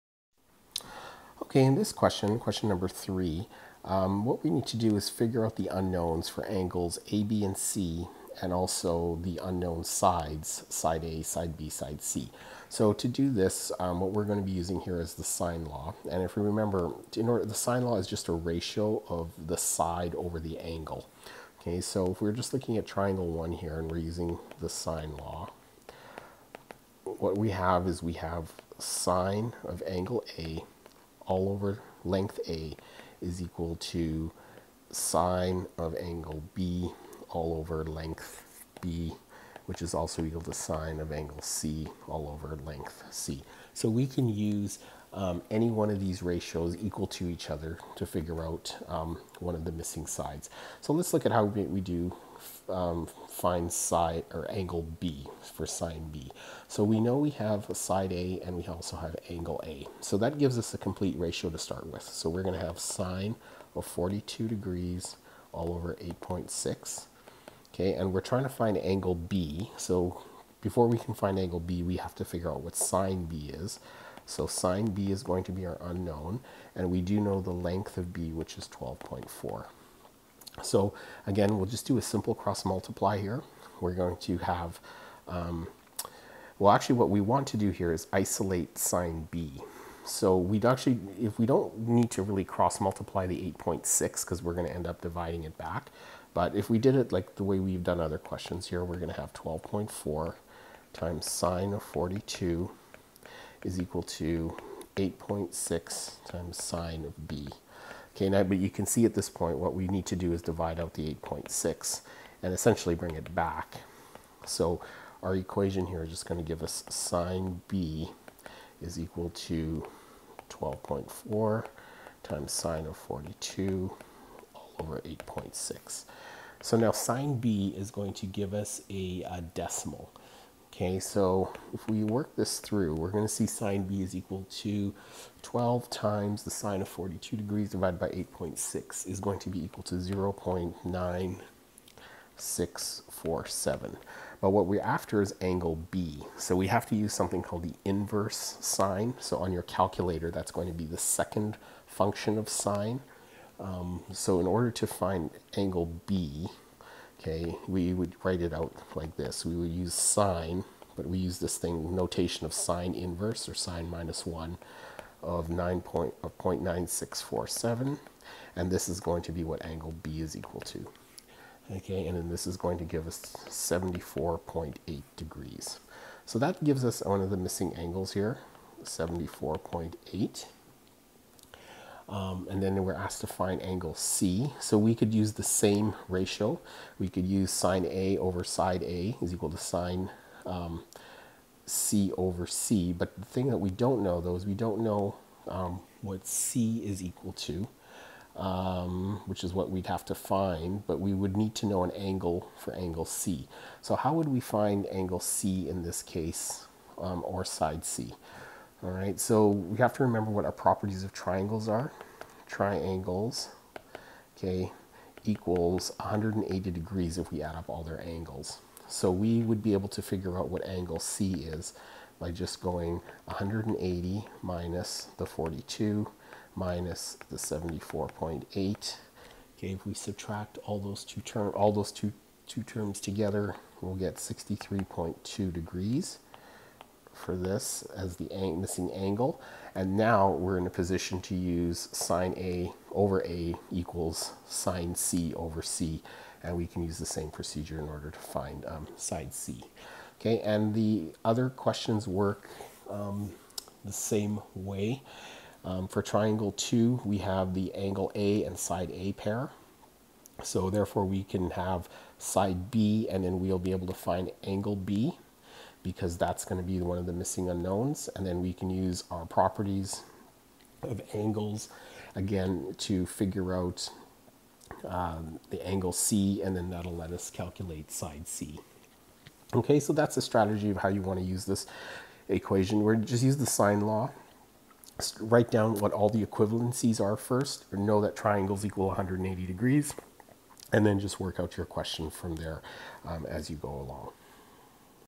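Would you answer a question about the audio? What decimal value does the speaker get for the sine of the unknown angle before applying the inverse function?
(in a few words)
0.9647.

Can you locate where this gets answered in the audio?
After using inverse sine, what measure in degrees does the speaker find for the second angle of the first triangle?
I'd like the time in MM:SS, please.
02:53.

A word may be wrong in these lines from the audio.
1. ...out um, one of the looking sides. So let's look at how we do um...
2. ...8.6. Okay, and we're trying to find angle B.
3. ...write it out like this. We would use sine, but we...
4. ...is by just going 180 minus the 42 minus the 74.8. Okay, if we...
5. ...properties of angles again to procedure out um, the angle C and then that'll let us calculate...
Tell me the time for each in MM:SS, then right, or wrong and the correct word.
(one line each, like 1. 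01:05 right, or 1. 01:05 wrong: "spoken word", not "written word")
1. 00:48 wrong: "missing", not "looking"
2. 01:06 right
3. 02:38 right
4. 03:41 right
5. 04:29 wrong: "figure", not "procedure".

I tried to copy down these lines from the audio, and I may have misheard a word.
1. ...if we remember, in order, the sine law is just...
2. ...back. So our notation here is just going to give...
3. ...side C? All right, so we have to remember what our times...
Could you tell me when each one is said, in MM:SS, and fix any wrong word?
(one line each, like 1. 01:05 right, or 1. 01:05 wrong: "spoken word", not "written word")
1. 00:16 right
2. 01:53 wrong: "equation", not "notation"
3. 03:27 wrong: "properties", not "times".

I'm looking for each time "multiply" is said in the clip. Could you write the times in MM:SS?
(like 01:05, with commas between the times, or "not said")
01:22, 01:32.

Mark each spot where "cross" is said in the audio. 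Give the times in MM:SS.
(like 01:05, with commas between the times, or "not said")
01:22, 01:32.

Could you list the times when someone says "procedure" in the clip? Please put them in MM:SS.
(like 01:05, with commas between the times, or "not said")
04:07.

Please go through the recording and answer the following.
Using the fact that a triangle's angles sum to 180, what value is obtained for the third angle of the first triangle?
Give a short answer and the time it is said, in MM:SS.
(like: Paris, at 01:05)
63.2 degrees, at 03:54.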